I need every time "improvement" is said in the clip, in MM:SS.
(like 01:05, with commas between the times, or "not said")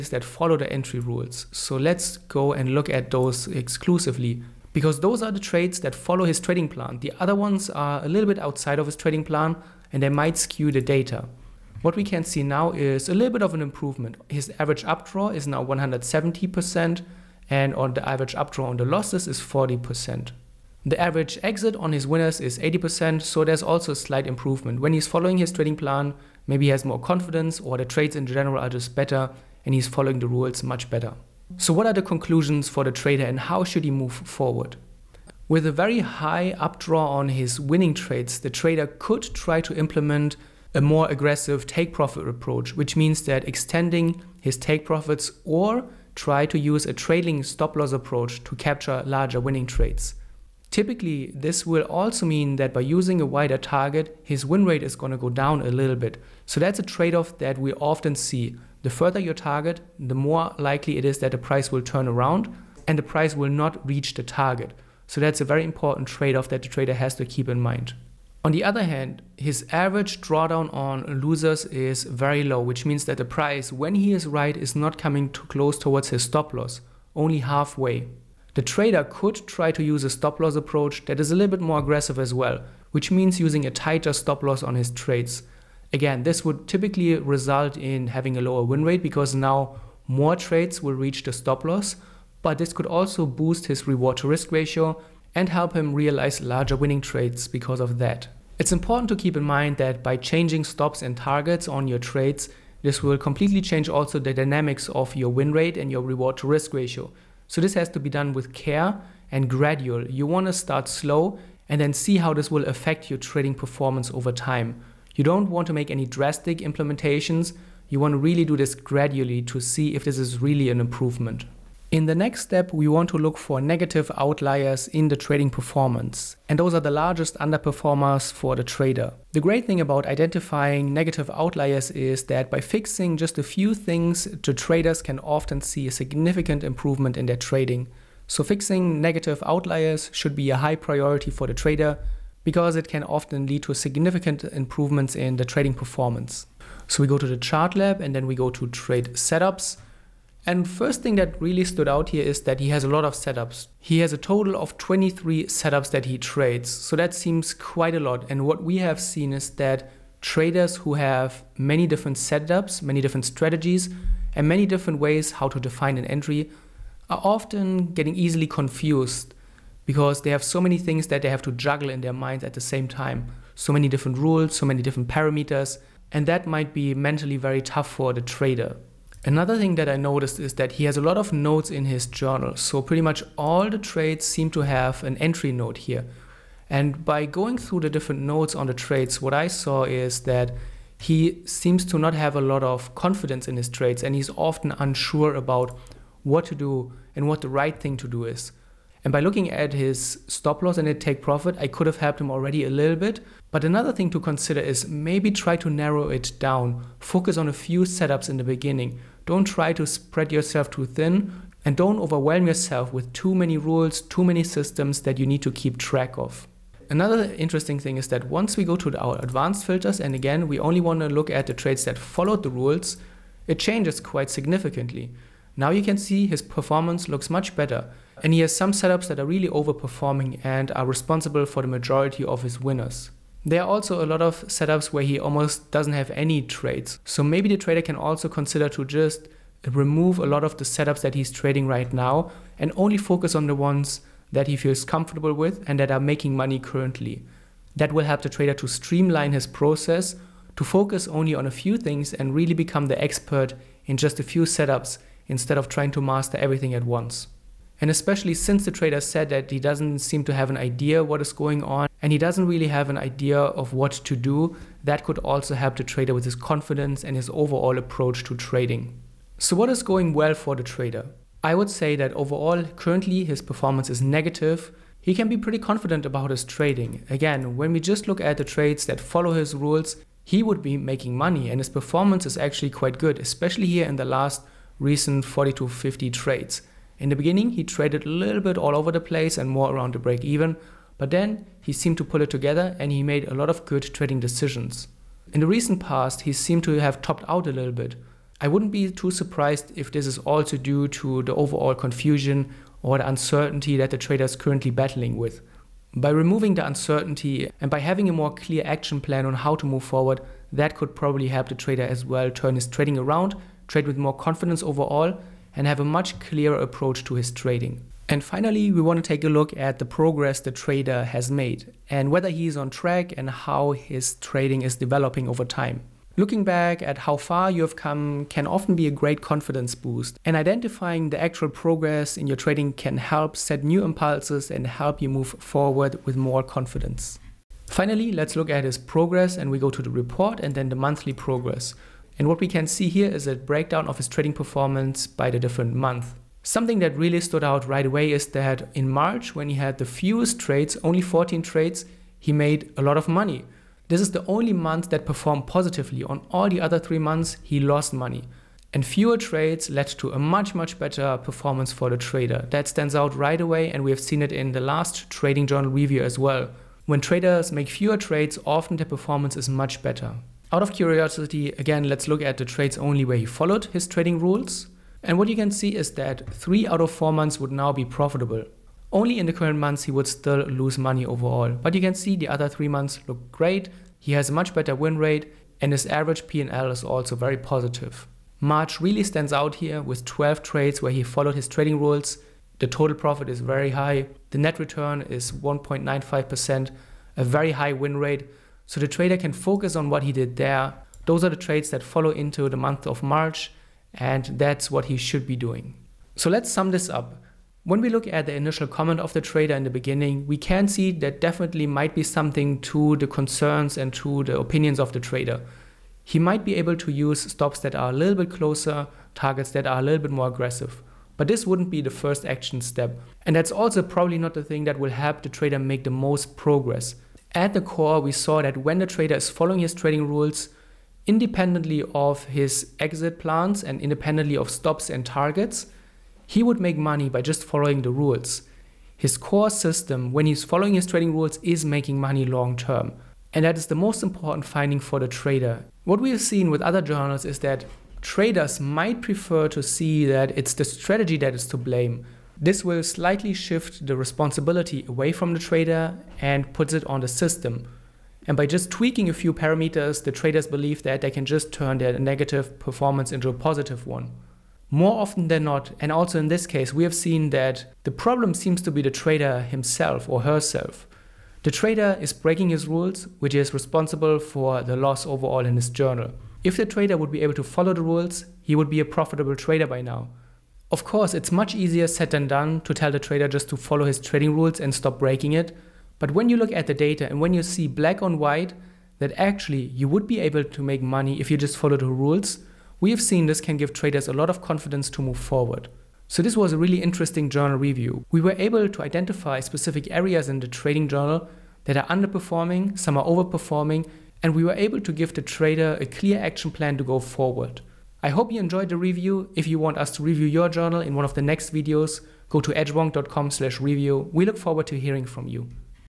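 00:13, 00:24, 02:00, 02:16, 02:24.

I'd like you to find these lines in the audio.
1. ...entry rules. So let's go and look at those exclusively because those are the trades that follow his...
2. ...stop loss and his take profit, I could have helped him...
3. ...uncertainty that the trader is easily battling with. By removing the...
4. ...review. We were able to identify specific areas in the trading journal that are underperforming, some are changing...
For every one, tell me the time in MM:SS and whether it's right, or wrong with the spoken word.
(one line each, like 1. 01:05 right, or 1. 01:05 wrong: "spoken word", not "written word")
1. 00:00 right
2. 03:20 right
3. 05:03 wrong: "currently", not "easily"
4. 08:17 wrong: "overperforming", not "changing".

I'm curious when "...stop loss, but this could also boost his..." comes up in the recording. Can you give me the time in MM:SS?
01:31.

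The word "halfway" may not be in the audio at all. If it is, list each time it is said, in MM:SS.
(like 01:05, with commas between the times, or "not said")
01:17.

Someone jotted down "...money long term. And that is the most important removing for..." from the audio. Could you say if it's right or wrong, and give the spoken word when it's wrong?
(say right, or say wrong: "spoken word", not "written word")
wrong: "finding", not "removing".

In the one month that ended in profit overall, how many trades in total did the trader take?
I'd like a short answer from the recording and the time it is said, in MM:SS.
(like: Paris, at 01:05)
14, at 05:51.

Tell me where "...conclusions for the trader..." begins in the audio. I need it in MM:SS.
00:32.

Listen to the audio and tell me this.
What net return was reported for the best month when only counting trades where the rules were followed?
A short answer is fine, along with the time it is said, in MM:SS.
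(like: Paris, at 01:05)
1.95%, at 06:35.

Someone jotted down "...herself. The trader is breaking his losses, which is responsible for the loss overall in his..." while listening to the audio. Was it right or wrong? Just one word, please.
wrong.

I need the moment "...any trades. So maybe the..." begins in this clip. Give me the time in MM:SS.
03:56.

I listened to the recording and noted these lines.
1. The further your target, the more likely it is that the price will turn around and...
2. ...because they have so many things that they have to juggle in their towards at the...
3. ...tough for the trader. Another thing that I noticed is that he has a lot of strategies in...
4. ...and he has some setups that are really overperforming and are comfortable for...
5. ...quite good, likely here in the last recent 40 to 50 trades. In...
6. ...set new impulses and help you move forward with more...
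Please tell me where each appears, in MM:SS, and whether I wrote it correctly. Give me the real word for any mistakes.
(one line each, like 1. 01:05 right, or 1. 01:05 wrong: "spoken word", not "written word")
1. 00:58 right
2. 02:49 wrong: "minds", not "towards"
3. 02:57 wrong: "notes", not "strategies"
4. 03:48 wrong: "responsible", not "comfortable"
5. 04:42 wrong: "especially", not "likely"
6. 05:33 right.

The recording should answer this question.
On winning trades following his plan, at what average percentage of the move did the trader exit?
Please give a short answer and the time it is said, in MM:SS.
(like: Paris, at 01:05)
80%, at 00:22.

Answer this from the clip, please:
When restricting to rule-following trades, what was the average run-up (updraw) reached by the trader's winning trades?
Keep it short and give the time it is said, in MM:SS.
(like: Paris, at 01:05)
170%, at 00:15.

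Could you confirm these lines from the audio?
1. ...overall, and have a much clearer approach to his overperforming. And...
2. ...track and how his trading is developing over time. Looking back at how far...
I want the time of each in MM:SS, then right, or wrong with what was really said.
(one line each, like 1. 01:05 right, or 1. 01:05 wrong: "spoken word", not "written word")
1. 05:14 wrong: "trading", not "overperforming"
2. 05:22 right.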